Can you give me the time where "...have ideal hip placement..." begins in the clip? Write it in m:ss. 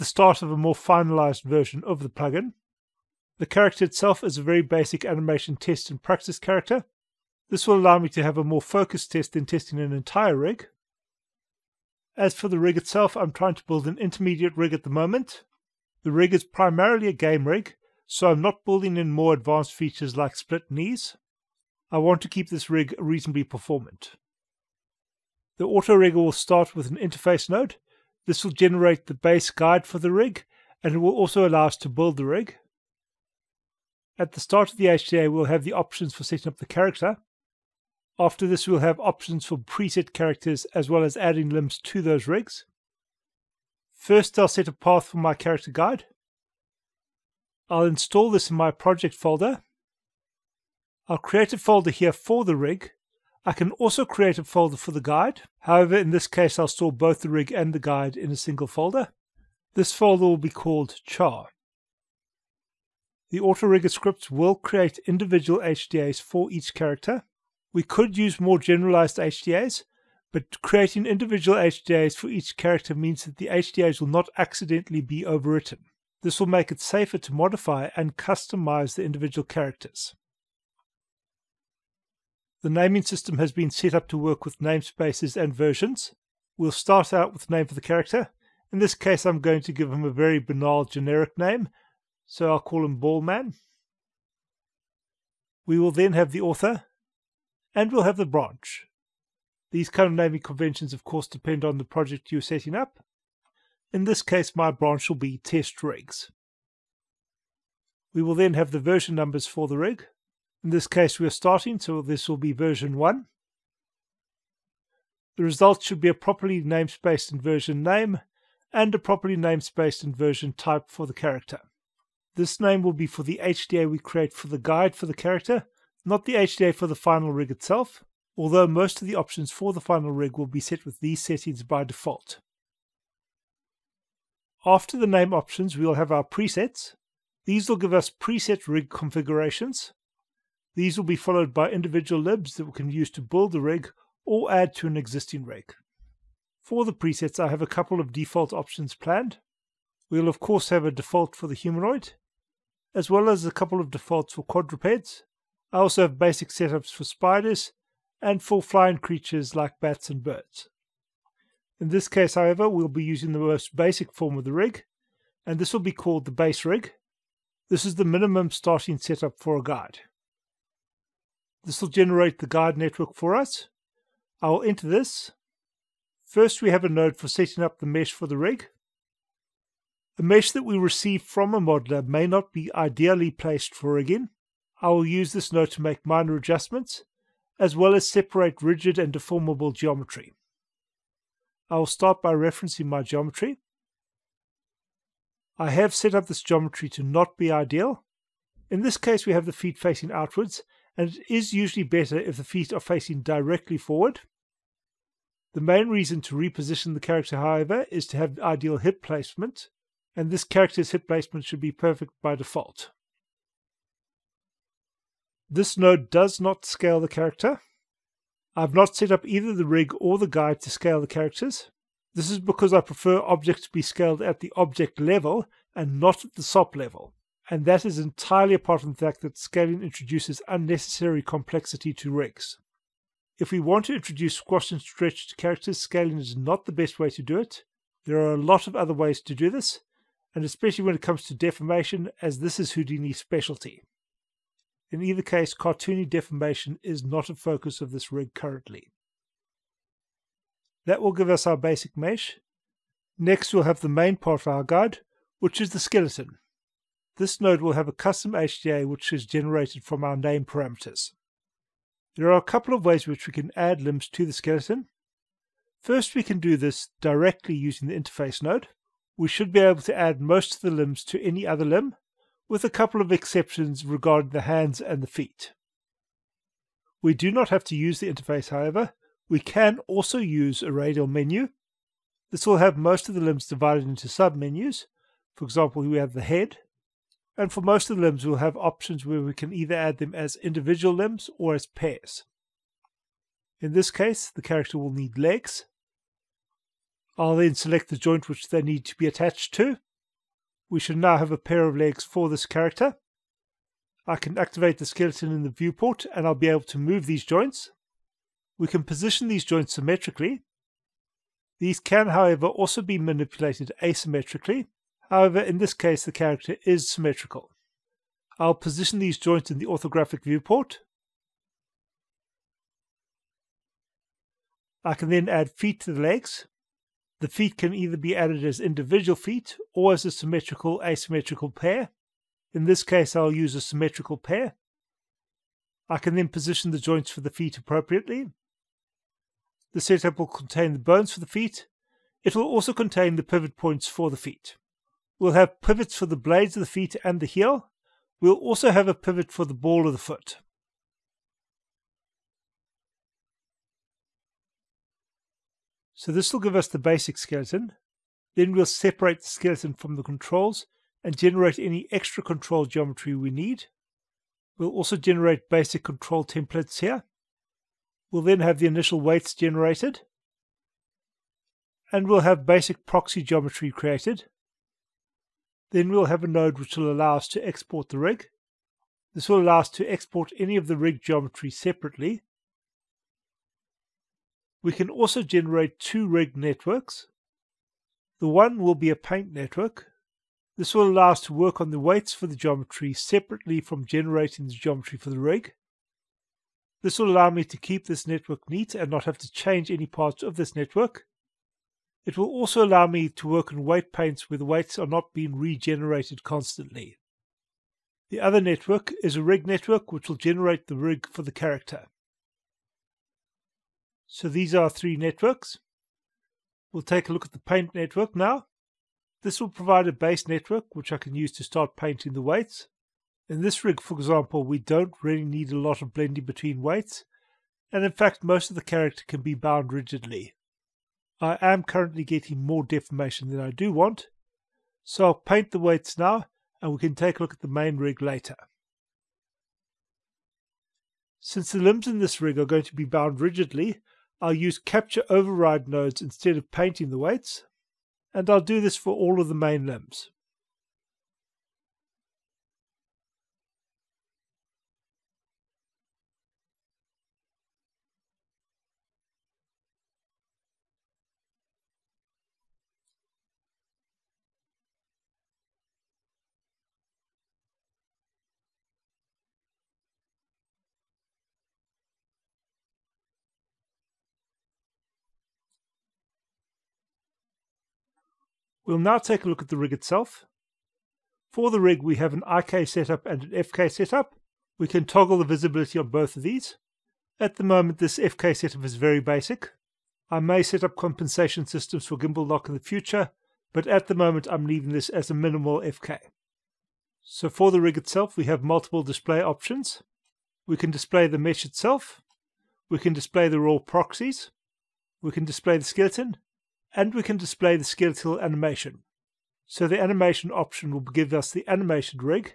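3:28.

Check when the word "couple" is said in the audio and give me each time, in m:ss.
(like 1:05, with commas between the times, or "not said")
2:27, 2:33, 4:22, 4:32.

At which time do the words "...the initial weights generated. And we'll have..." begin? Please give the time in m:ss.
6:08.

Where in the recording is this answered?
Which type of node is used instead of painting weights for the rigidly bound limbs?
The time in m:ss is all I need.
7:24.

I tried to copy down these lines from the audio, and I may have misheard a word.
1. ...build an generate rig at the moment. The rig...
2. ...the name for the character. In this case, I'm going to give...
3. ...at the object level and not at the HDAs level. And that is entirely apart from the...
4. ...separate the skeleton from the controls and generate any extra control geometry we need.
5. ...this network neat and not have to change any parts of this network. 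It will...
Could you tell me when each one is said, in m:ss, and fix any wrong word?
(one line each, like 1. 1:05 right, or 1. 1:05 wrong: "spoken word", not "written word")
1. 0:13 wrong: "intermediate", not "generate"
2. 1:27 right
3. 3:44 wrong: "SOP", not "HDAs"
4. 5:58 right
5. 6:37 right.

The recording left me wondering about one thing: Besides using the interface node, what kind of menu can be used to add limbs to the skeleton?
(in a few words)
radial menu.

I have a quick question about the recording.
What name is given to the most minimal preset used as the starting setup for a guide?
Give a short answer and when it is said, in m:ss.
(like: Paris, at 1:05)
base rig, at 2:46.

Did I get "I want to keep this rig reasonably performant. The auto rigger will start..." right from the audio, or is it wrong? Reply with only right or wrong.
right.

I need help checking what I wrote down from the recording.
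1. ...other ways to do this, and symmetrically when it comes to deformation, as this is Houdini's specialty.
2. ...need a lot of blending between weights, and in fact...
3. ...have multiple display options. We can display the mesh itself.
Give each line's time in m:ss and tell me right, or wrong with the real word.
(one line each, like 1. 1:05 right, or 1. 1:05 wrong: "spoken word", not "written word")
1. 3:58 wrong: "especially", not "symmetrically"
2. 7:05 right
3. 8:18 right.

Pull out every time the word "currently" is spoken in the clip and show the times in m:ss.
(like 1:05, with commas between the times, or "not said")
4:08, 7:11.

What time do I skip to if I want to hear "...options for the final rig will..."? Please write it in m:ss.
2:09.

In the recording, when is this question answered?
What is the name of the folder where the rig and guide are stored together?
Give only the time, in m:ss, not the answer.
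1:01.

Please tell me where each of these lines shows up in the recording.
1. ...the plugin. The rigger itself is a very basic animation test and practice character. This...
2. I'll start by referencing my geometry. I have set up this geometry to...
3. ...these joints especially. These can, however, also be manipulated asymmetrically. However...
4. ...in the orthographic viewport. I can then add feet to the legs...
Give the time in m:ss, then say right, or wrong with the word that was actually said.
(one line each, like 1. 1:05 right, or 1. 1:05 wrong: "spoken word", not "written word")
1. 0:02 wrong: "character", not "rigger"
2. 3:11 right
3. 5:09 wrong: "symmetrically", not "especially"
4. 5:19 right.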